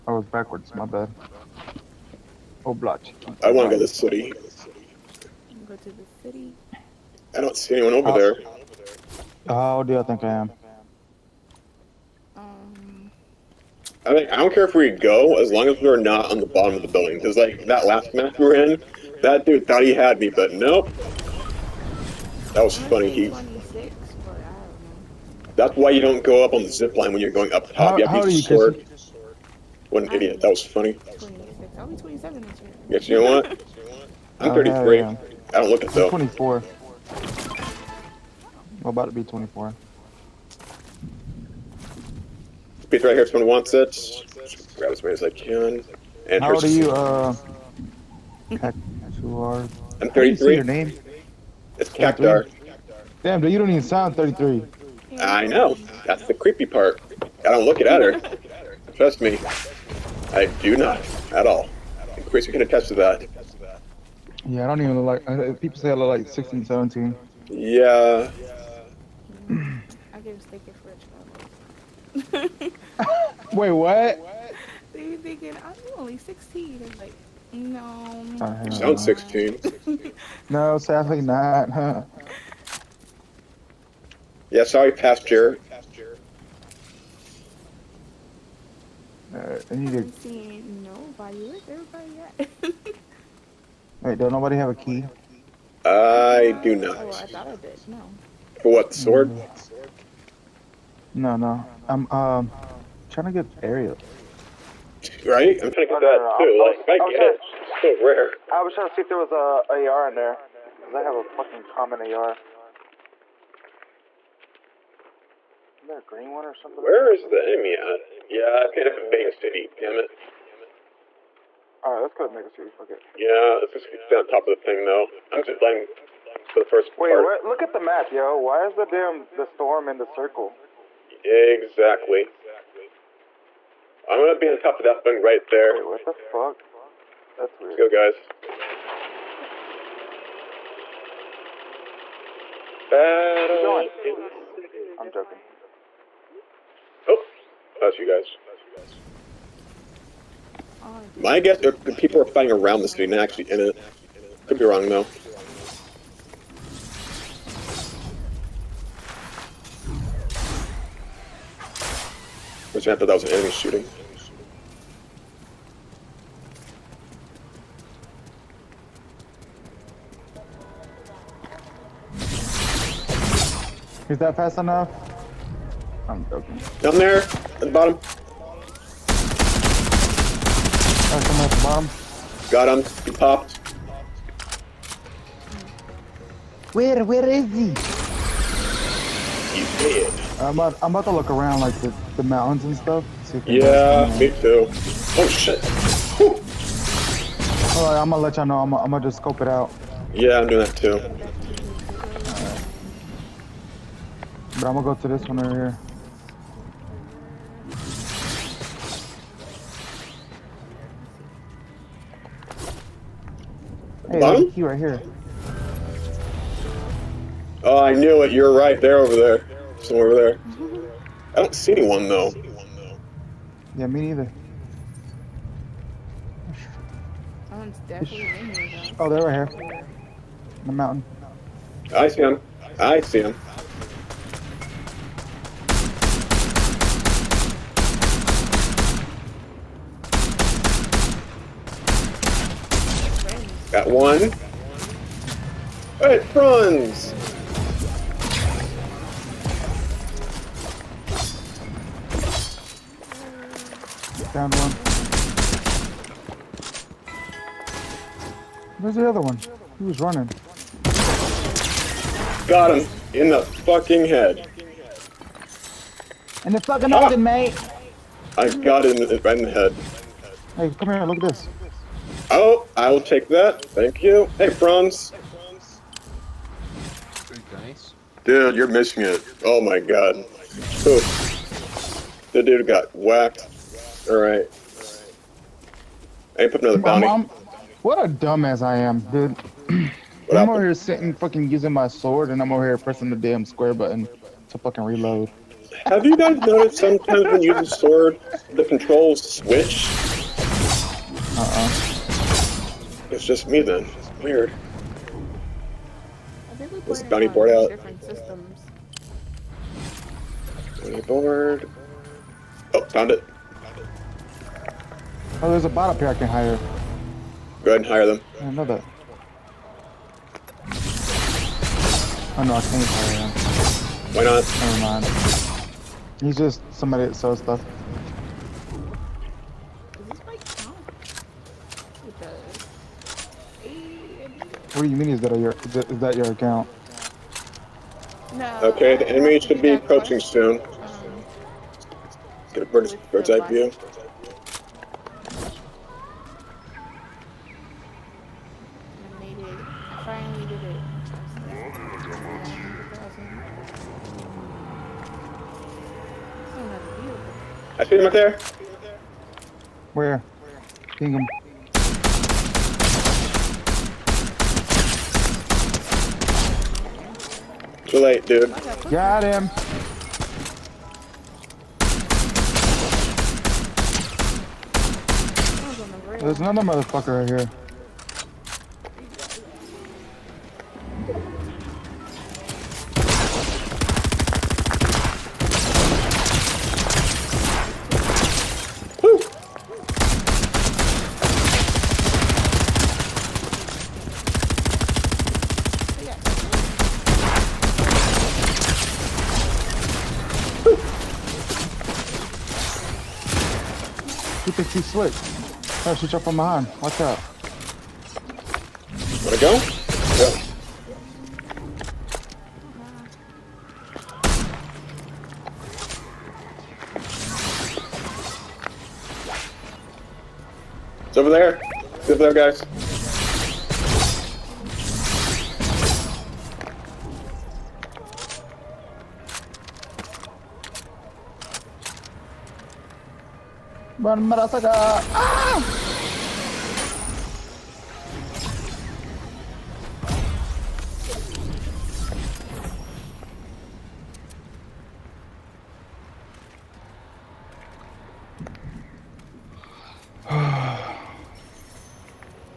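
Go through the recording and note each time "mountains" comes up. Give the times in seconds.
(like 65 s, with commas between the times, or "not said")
192 s, 230 s.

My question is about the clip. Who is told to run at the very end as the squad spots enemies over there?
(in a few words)
Murasaka.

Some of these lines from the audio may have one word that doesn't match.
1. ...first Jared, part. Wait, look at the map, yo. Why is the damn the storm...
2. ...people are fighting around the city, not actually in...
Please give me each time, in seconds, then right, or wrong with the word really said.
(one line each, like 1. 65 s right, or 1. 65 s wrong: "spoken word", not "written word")
1. 126 s wrong: "Wait", not "Jared"
2. 151 s right.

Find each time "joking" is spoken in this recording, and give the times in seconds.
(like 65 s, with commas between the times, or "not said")
145 s, 176 s.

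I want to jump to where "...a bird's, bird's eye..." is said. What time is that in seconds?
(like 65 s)
342 s.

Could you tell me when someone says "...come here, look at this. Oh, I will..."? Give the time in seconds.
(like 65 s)
270 s.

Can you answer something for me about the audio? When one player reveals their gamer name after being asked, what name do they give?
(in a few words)
Cactuar.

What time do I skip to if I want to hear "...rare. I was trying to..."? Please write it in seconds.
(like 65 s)
108 s.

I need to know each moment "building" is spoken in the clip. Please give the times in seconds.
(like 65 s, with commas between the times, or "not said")
16 s.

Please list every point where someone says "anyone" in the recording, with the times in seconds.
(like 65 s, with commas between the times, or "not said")
7 s, 221 s.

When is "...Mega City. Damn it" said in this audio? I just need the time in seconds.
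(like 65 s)
118 s.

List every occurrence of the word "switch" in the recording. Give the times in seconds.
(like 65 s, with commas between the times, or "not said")
299 s.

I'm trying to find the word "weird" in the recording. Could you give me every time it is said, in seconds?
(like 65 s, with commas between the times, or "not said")
137 s, 304 s.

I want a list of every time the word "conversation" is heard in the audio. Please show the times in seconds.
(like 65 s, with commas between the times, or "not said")
not said.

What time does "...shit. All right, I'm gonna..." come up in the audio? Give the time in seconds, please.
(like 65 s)
195 s.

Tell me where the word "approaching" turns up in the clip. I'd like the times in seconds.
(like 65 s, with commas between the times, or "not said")
339 s.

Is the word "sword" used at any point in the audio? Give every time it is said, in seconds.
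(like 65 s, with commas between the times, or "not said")
28 s, 98 s, 291 s, 297 s.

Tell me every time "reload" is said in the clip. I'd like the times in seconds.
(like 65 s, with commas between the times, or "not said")
294 s.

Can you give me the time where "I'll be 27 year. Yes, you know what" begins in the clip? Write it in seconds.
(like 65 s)
31 s.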